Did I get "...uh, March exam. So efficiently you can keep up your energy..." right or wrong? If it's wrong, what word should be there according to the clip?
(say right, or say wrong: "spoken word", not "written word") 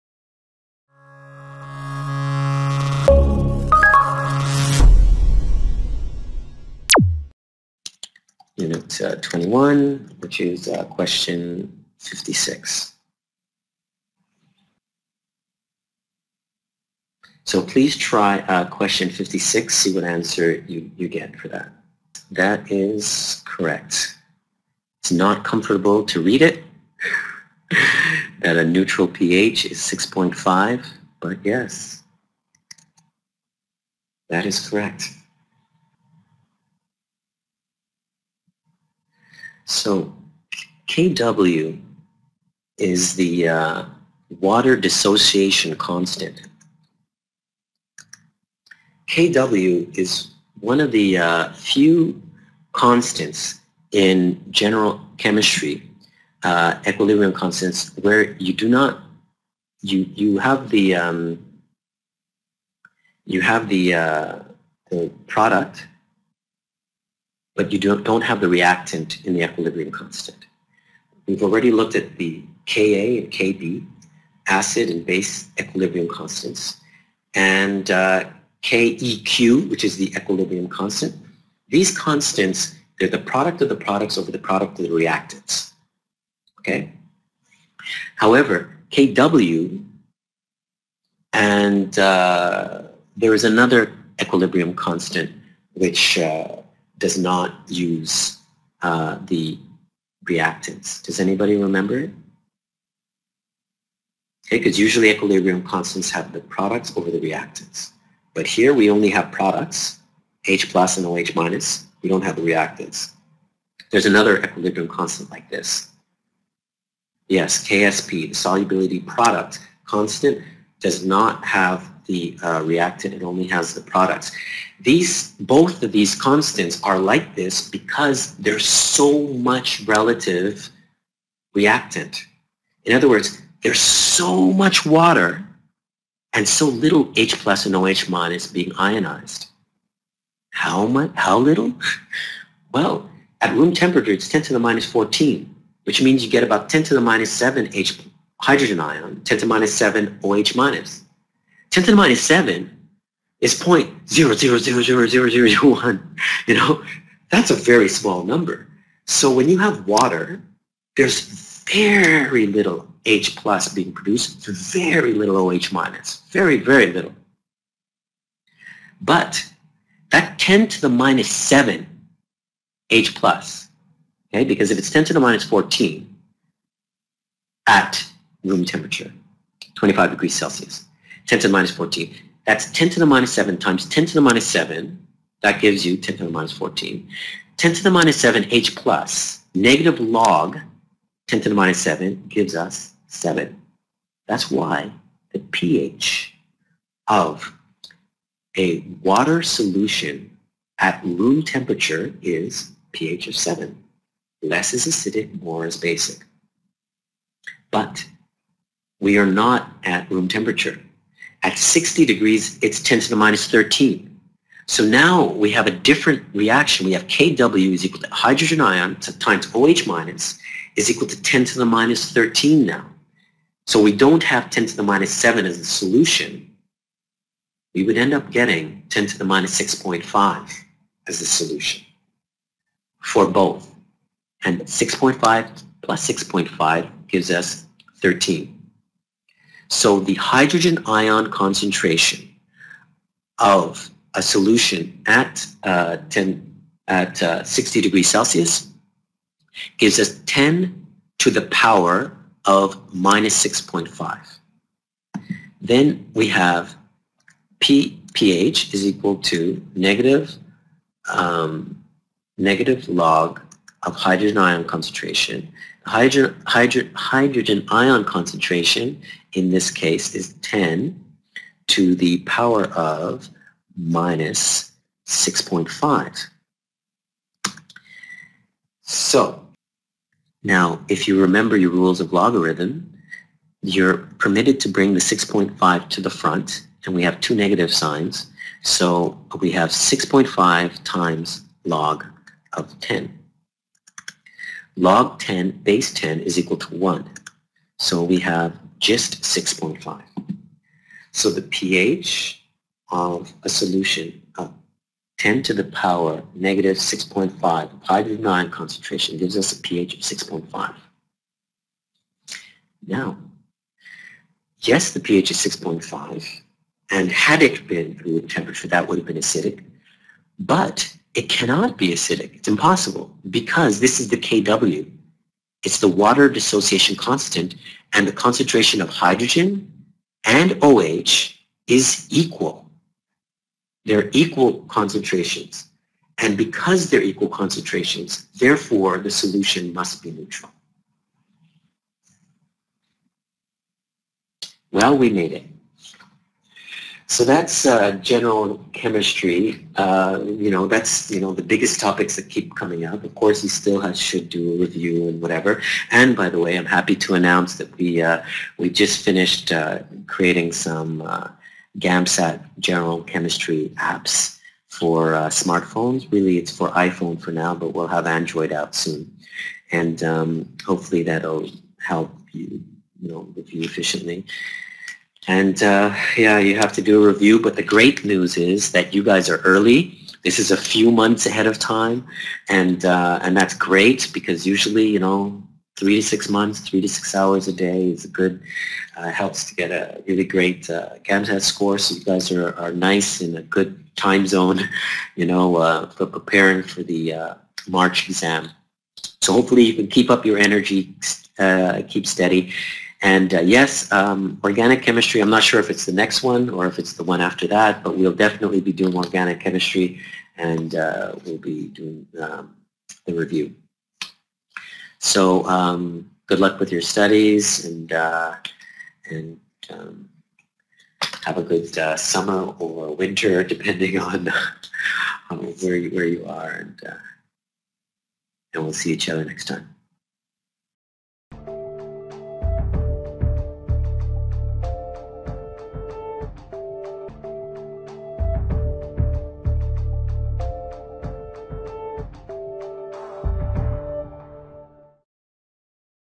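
wrong: "hopefully", not "efficiently".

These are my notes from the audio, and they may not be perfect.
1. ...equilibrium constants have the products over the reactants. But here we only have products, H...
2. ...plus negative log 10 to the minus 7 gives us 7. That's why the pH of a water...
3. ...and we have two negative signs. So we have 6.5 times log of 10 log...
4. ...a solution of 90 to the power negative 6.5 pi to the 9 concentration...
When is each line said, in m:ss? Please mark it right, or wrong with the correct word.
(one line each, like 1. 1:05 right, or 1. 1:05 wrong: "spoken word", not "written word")
1. 1:45 right
2. 3:08 right
3. 4:46 right
4. 5:03 wrong: "10", not "90".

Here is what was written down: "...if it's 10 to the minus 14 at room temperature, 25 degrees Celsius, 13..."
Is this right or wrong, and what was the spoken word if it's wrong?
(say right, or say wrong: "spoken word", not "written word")
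wrong: "10", not "13".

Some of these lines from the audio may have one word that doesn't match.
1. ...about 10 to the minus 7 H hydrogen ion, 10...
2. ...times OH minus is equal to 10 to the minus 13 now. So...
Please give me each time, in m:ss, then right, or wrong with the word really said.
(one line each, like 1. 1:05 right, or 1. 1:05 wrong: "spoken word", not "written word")
1. 2:26 right
2. 3:38 right.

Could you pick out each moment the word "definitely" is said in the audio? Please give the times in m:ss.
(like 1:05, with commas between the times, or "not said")
6:48.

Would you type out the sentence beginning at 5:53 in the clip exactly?
Of course, he still has, should do a review and whatever.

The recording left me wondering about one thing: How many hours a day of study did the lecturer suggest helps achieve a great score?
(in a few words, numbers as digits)
3 to 6 hours.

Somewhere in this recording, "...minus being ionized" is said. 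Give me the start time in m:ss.
2:18.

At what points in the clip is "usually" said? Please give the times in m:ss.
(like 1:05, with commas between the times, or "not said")
1:44, 6:24.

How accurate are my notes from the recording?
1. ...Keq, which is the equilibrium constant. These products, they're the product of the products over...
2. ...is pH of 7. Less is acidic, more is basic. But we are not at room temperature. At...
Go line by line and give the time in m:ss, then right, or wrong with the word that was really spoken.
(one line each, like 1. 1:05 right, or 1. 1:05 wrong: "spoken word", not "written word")
1. 1:18 wrong: "constants", not "products"
2. 3:22 right.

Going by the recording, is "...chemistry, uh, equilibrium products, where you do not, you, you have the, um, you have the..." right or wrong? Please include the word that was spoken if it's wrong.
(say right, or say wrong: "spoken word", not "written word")
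wrong: "constants", not "products".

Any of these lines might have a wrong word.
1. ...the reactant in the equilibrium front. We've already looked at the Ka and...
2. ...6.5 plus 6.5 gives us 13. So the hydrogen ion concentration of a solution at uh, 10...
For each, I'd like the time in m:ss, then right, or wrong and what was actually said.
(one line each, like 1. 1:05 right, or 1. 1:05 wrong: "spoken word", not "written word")
1. 1:08 wrong: "constant", not "front"
2. 3:54 right.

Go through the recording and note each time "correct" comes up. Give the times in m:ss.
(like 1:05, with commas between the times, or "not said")
0:23, 0:34.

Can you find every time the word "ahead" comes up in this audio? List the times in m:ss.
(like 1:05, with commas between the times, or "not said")
6:21.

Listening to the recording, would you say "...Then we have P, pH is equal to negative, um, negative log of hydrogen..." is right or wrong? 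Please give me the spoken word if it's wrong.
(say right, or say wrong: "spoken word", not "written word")
right.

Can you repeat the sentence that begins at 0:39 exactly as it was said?
So KW is the uh, water dissociation constant.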